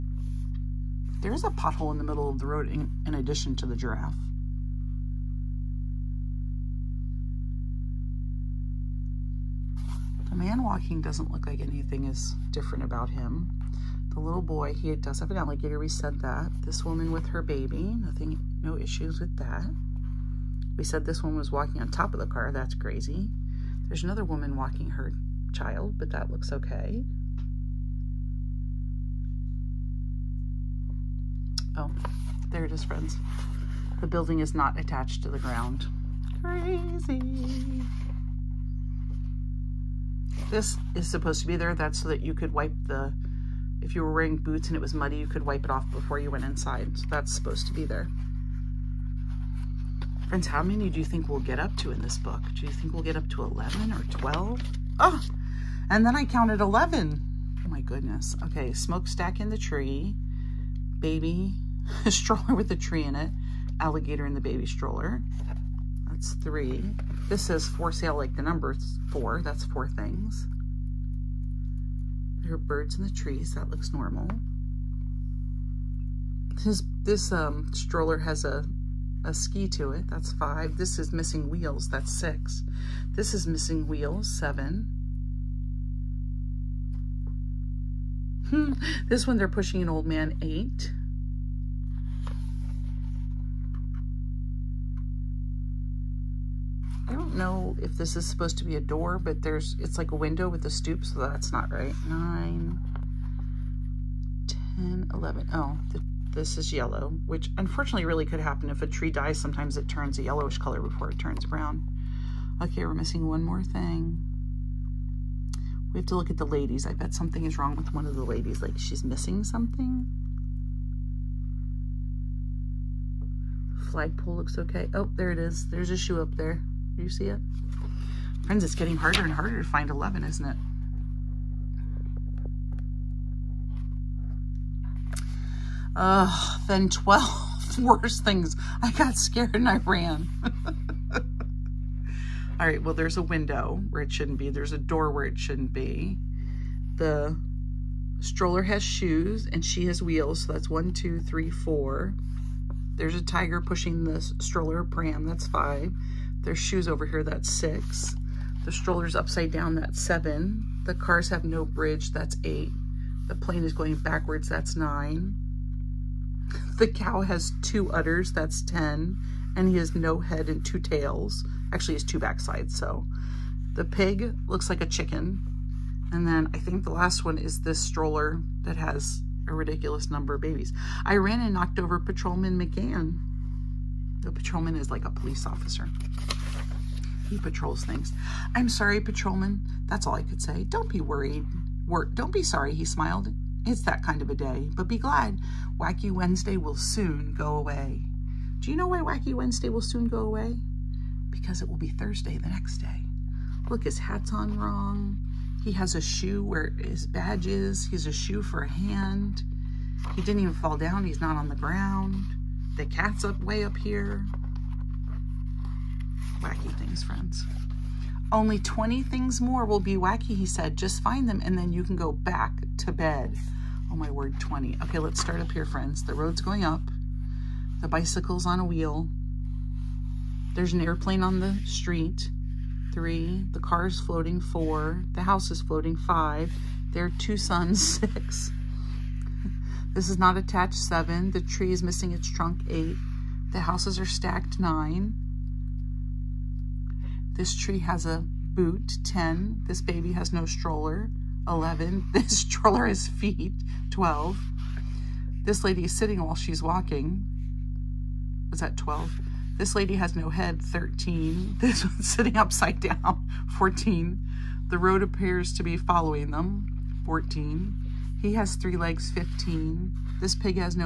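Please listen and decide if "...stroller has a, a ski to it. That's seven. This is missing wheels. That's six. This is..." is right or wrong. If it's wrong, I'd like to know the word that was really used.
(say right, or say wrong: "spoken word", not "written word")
wrong: "five", not "seven".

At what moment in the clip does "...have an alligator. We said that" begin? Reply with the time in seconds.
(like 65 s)
15 s.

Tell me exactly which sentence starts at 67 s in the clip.
This says for sale like the number's four.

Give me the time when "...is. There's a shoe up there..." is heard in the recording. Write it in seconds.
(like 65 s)
125 s.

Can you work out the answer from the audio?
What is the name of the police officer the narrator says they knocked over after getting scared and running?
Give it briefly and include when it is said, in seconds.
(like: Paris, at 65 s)
Patrolman McGann, at 181 s.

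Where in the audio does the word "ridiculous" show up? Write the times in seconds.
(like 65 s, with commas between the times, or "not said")
179 s.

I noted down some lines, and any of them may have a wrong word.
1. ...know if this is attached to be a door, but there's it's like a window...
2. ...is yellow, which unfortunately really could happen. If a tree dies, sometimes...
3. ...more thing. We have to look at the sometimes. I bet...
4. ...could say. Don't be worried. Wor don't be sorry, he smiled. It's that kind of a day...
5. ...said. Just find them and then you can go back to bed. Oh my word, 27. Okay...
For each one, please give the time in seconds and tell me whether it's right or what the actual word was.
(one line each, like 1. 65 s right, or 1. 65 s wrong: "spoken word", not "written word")
1. 97 s wrong: "supposed", not "attached"
2. 106 s right
3. 113 s wrong: "ladies", not "sometimes"
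4. 190 s right
5. 220 s wrong: "20", not "27".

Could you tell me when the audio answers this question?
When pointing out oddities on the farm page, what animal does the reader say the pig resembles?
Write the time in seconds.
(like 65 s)
174 s.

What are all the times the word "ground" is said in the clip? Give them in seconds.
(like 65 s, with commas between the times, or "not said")
35 s, 211 s.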